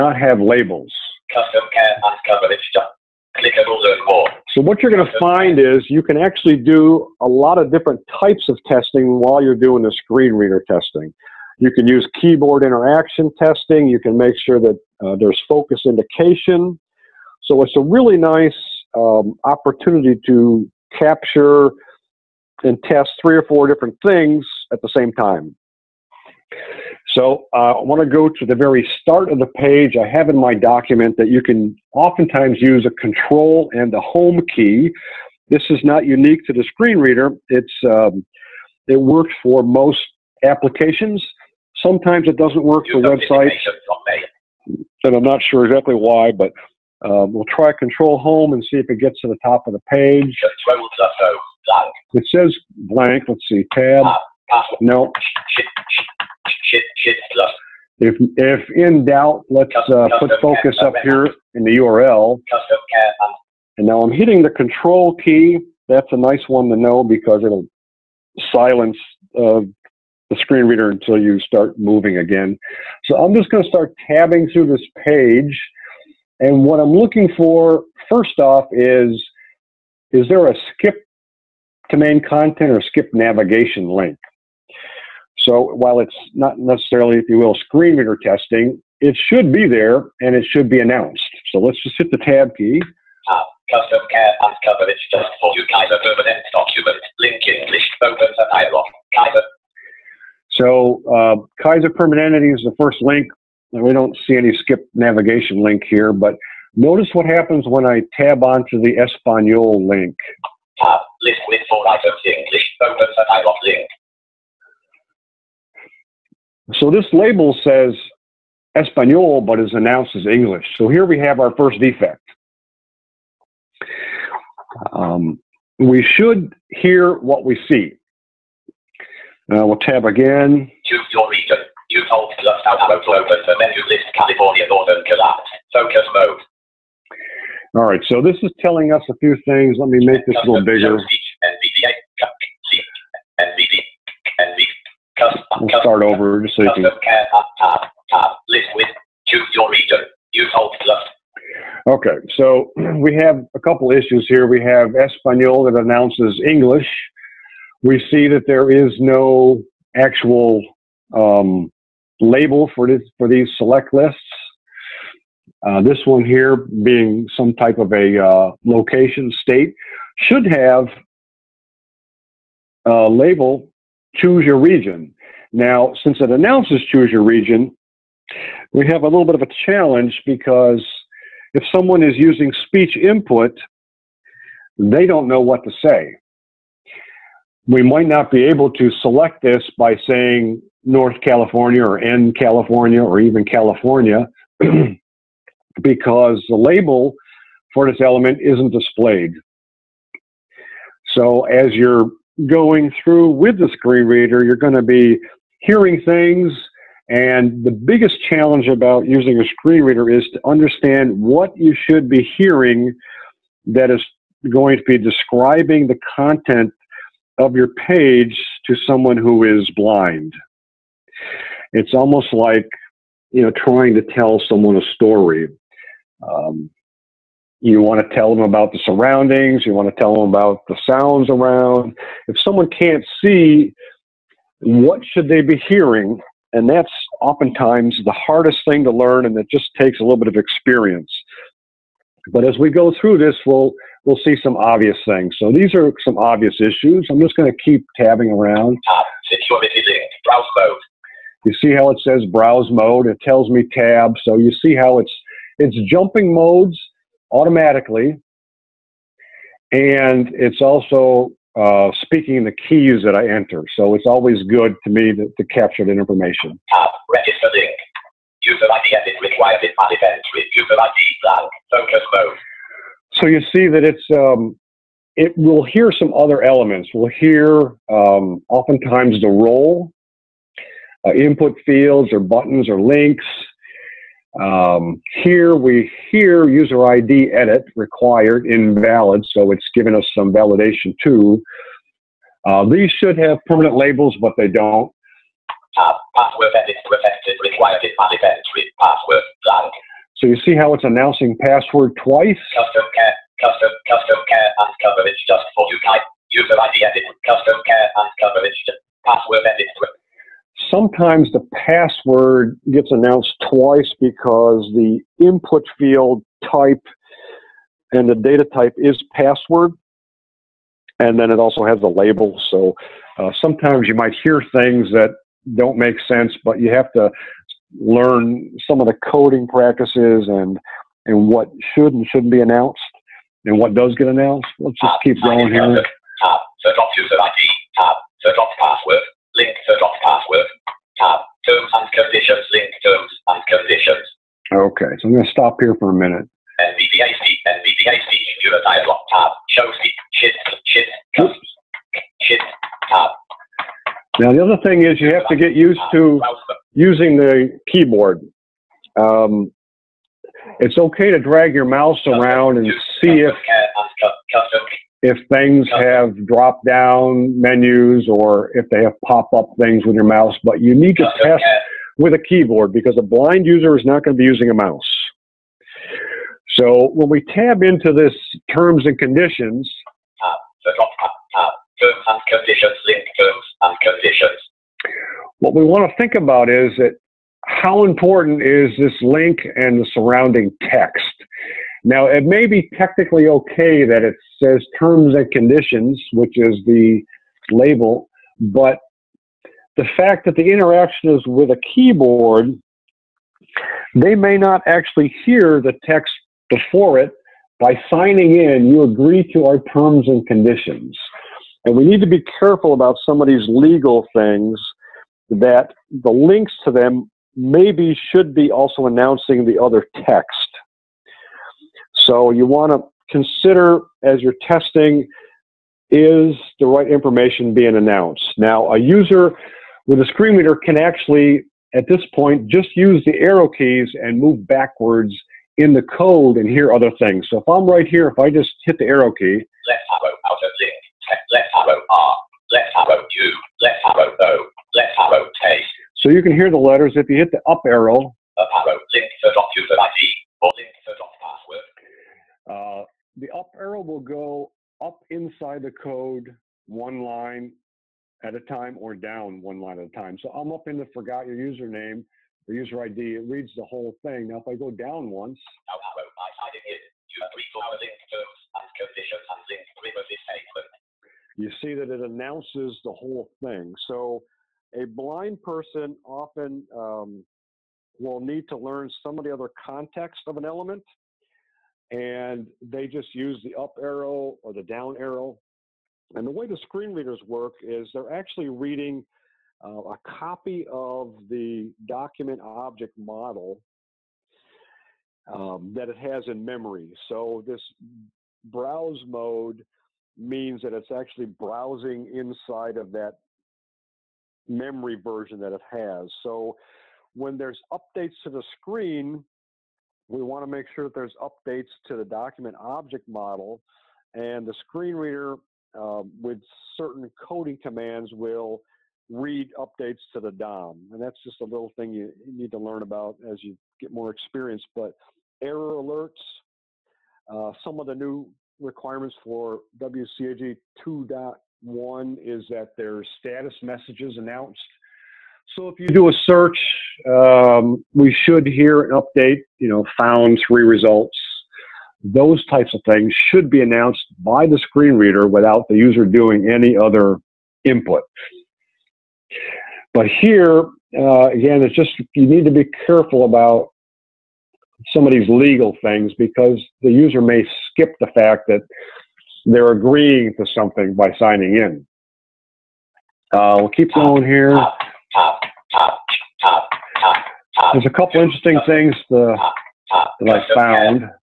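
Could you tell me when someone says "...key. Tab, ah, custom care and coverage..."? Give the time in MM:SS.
01:32.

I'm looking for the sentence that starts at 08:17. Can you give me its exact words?
So this browse mode means that it's actually browsing inside of that memory version that it has.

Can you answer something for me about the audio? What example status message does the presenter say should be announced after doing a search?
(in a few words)
Found three results.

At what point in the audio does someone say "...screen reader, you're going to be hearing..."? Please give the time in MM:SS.
03:23.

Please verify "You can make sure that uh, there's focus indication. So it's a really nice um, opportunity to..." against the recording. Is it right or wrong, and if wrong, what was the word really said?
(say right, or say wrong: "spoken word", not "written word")
right.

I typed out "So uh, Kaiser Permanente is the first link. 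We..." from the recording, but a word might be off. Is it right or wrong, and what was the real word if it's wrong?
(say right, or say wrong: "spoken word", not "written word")
right.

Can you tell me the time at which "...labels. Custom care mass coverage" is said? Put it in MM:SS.
00:00.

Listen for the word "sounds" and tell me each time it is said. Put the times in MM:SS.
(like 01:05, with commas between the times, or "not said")
03:50.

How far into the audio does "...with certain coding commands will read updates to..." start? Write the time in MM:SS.
08:36.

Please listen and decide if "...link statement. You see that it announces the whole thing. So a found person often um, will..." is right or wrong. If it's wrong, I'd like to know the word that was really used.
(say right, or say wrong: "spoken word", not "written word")
wrong: "blind", not "found".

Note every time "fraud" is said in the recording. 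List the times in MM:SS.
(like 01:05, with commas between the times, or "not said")
not said.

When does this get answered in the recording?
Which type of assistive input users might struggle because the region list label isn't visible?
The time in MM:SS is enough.
03:02.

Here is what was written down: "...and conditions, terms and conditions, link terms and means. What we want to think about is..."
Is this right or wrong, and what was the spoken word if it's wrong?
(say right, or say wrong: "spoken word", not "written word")
wrong: "conditions", not "means".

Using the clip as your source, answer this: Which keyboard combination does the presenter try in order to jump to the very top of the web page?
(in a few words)
Control Home.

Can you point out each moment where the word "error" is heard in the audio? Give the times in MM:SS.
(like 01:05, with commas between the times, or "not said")
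08:45.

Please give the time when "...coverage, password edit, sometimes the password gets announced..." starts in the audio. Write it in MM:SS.
05:08.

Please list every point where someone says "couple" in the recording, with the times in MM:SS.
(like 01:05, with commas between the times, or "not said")
02:33, 09:27.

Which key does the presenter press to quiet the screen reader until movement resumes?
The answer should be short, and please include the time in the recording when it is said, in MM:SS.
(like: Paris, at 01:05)
Control key, at 01:04.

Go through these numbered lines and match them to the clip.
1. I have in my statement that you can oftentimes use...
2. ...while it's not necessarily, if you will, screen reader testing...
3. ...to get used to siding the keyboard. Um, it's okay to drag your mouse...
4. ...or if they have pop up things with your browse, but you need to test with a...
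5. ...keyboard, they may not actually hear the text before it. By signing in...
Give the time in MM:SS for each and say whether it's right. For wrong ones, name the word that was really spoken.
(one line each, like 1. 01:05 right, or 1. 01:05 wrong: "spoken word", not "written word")
1. 00:29 wrong: "document", not "statement"
2. 01:25 right
3. 05:55 wrong: "using", not "siding"
4. 06:08 wrong: "mouse", not "browse"
5. 06:41 right.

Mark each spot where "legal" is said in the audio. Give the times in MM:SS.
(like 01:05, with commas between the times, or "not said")
06:53, 09:15.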